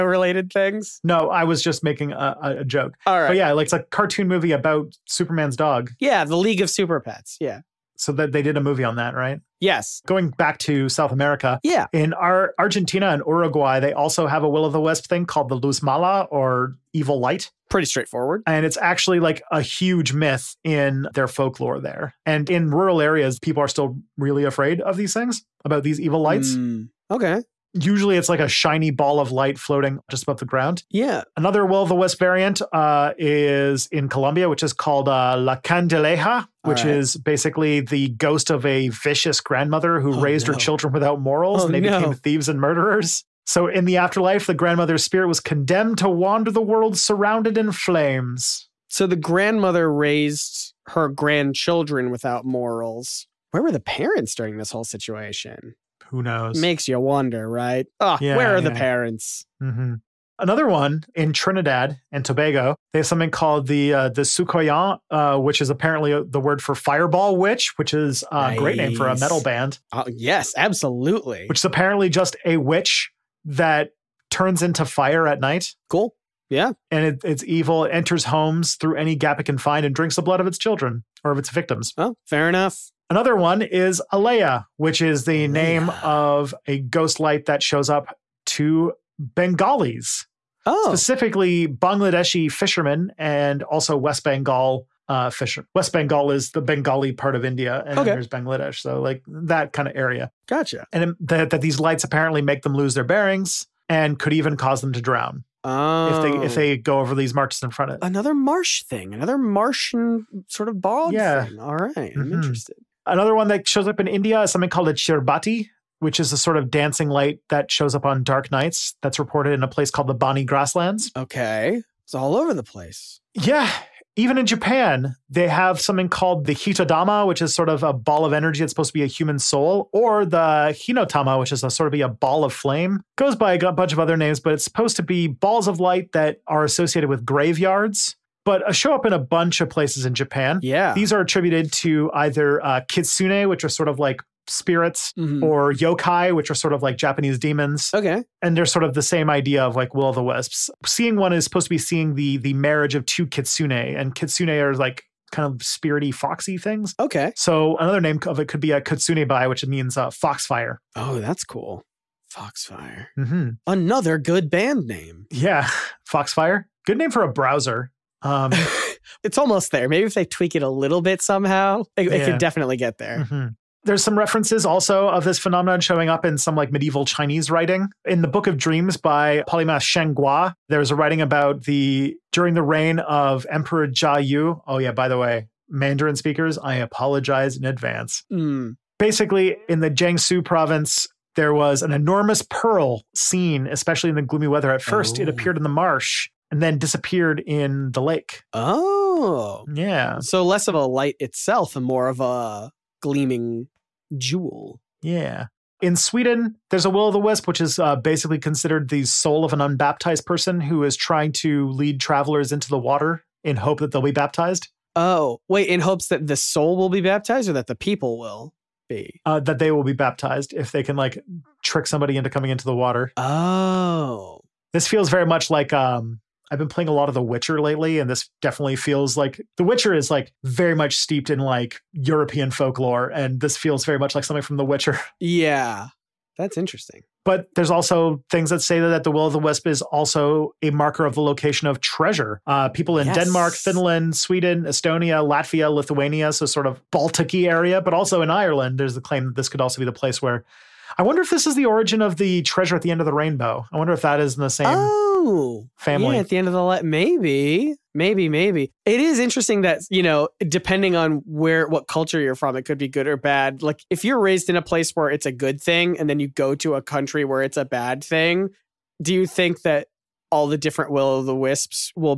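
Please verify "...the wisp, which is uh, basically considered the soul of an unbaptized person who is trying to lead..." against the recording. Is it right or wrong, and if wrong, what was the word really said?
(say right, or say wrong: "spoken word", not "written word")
right.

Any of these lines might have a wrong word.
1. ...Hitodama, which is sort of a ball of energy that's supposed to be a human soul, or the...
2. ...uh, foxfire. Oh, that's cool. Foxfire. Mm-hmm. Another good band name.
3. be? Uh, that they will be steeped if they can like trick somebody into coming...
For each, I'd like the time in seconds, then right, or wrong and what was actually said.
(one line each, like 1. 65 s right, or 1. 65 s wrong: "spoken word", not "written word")
1. 126 s right
2. 159 s right
3. 218 s wrong: "baptized", not "steeped".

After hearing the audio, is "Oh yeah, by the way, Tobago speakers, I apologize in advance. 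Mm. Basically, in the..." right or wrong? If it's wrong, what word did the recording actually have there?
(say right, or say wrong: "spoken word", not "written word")
wrong: "Mandarin", not "Tobago".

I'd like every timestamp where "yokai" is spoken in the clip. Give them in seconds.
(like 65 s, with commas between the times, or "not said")
145 s.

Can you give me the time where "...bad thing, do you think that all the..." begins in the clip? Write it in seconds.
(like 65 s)
267 s.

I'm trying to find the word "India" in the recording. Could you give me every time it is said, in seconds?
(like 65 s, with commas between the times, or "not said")
97 s, 114 s.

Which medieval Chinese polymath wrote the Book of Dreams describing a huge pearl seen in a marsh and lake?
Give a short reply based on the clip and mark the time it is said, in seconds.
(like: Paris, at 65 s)
Shen Gua, at 179 s.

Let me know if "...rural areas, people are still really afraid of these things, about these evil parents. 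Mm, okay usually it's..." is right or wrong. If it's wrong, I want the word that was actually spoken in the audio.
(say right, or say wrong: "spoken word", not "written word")
wrong: "lights", not "parents".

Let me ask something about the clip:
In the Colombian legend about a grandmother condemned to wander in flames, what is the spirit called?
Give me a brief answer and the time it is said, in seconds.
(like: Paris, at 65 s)
La Candileja, at 35 s.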